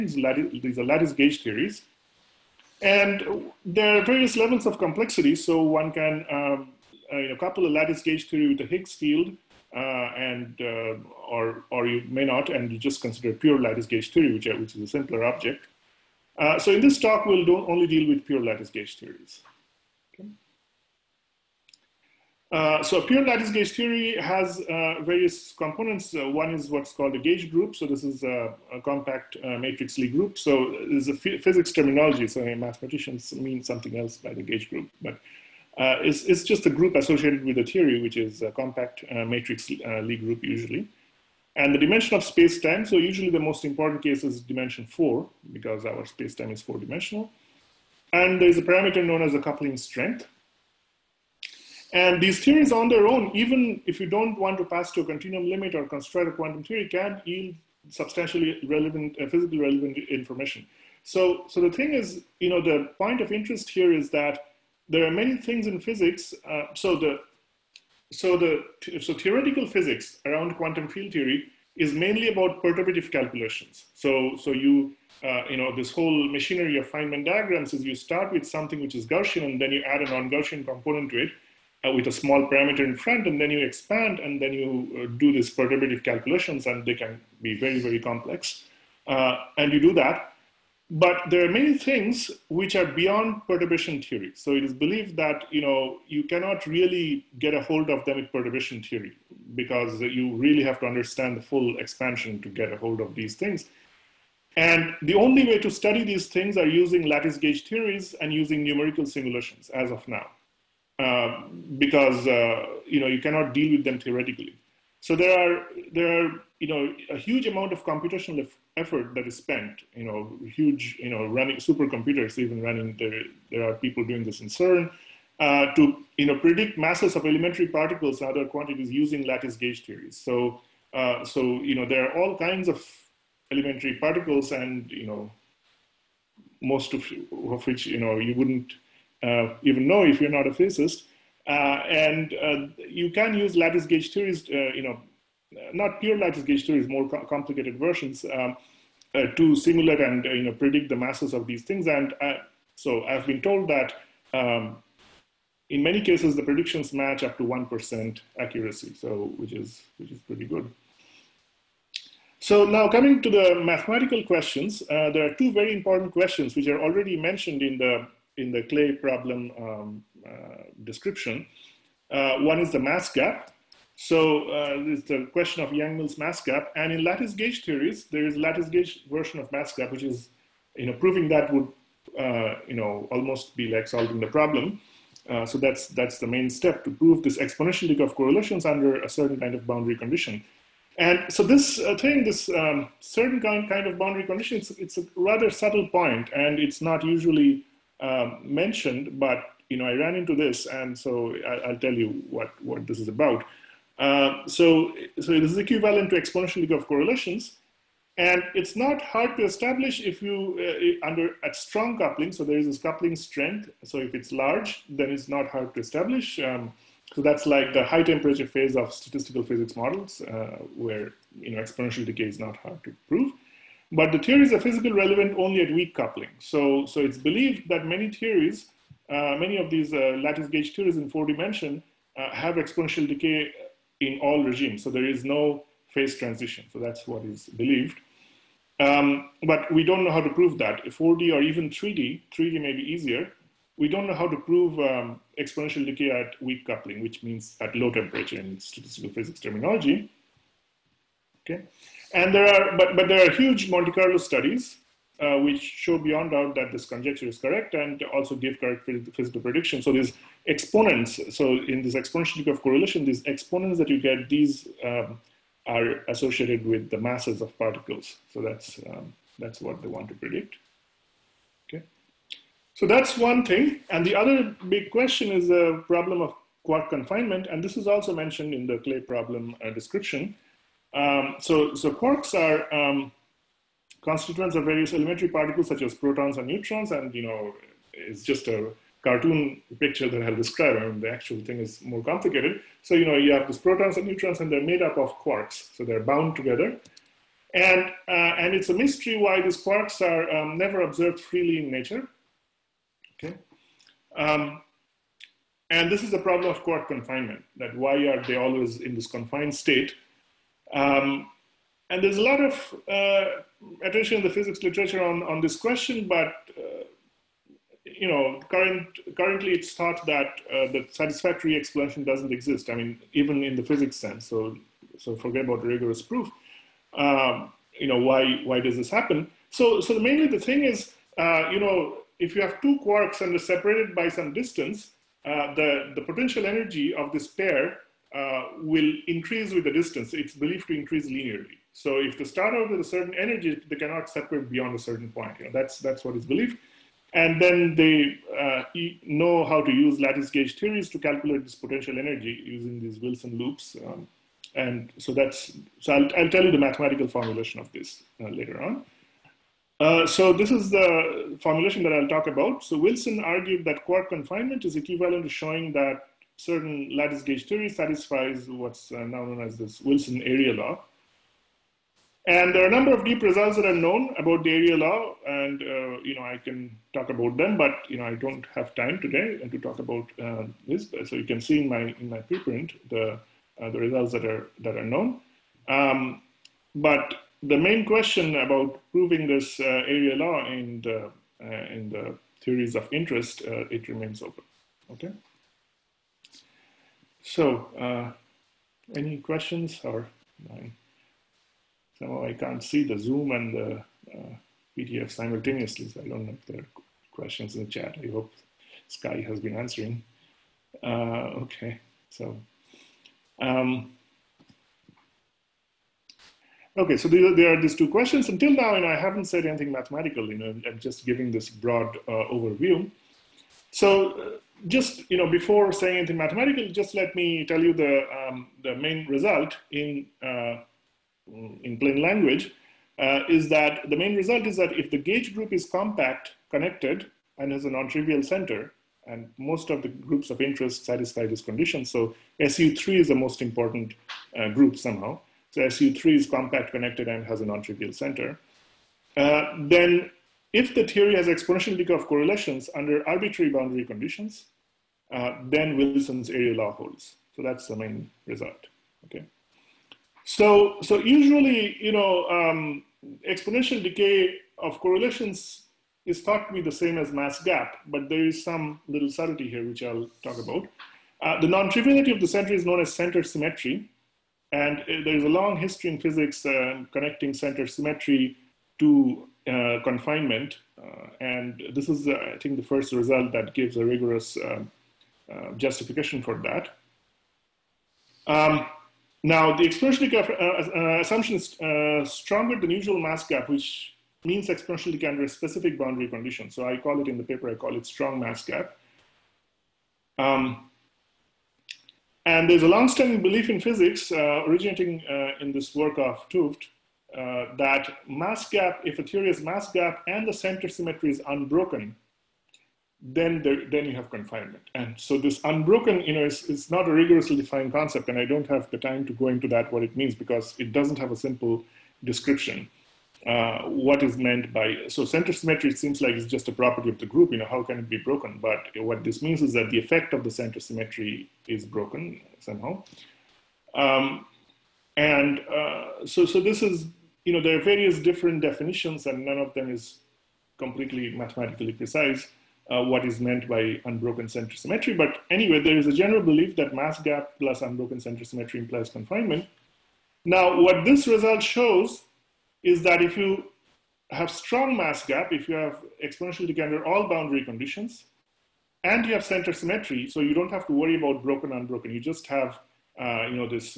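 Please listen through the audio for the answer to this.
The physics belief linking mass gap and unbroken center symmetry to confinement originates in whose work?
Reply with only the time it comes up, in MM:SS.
08:26.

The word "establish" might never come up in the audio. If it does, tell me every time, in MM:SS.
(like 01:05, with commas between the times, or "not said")
03:29, 03:35.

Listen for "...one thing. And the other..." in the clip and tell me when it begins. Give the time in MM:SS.
04:33.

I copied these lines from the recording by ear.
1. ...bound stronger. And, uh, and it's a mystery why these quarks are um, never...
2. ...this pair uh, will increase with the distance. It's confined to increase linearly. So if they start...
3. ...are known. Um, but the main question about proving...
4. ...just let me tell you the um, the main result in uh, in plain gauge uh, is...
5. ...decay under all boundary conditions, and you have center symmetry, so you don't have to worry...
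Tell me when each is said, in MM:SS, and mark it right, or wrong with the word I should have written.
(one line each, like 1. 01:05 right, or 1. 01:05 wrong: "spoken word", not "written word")
1. 04:56 wrong: "together", not "stronger"
2. 05:37 wrong: "believed", not "confined"
3. 06:24 right
4. 07:06 wrong: "language", not "gauge"
5. 09:16 right.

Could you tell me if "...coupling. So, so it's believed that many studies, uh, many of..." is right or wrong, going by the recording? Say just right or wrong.
wrong.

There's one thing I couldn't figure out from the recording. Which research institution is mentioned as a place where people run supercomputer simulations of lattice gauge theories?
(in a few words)
CERN.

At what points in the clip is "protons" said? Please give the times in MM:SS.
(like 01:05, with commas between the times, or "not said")
04:45, 04:53.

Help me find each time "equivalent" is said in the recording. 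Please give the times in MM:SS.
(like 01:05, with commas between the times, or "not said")
03:25, 06:04.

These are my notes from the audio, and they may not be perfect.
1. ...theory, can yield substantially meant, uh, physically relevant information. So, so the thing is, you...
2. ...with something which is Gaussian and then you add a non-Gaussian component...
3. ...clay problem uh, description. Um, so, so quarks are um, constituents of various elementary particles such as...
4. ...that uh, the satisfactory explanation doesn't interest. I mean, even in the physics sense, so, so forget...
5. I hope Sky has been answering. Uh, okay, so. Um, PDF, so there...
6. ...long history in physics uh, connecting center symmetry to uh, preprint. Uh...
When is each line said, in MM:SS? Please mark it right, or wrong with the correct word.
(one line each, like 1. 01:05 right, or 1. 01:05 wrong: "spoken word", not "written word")
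1. 00:56 wrong: "relevant", not "meant"
2. 01:18 right
3. 04:38 right
4. 05:20 wrong: "exist", not "interest"
5. 06:48 wrong: "Okay", not "PDF"
6. 07:55 wrong: "confinement", not "preprint".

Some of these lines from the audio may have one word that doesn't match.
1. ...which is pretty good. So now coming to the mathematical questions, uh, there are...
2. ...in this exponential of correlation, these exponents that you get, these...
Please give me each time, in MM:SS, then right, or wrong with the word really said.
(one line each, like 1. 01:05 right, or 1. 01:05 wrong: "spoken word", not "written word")
1. 02:39 right
2. 04:21 right.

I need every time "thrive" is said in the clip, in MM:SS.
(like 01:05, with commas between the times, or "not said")
not said.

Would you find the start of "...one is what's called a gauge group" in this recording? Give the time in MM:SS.
00:26.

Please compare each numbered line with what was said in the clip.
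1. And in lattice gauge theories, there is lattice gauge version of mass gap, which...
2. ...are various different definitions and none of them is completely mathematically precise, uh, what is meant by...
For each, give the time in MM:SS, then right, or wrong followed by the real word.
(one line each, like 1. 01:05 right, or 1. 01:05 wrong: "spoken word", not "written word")
1. 02:56 right
2. 08:57 right.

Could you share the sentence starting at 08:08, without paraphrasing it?
Um, now, the exponentially uh, assumption is stronger than usual mass gap, which means exponentially under specific boundary conditions.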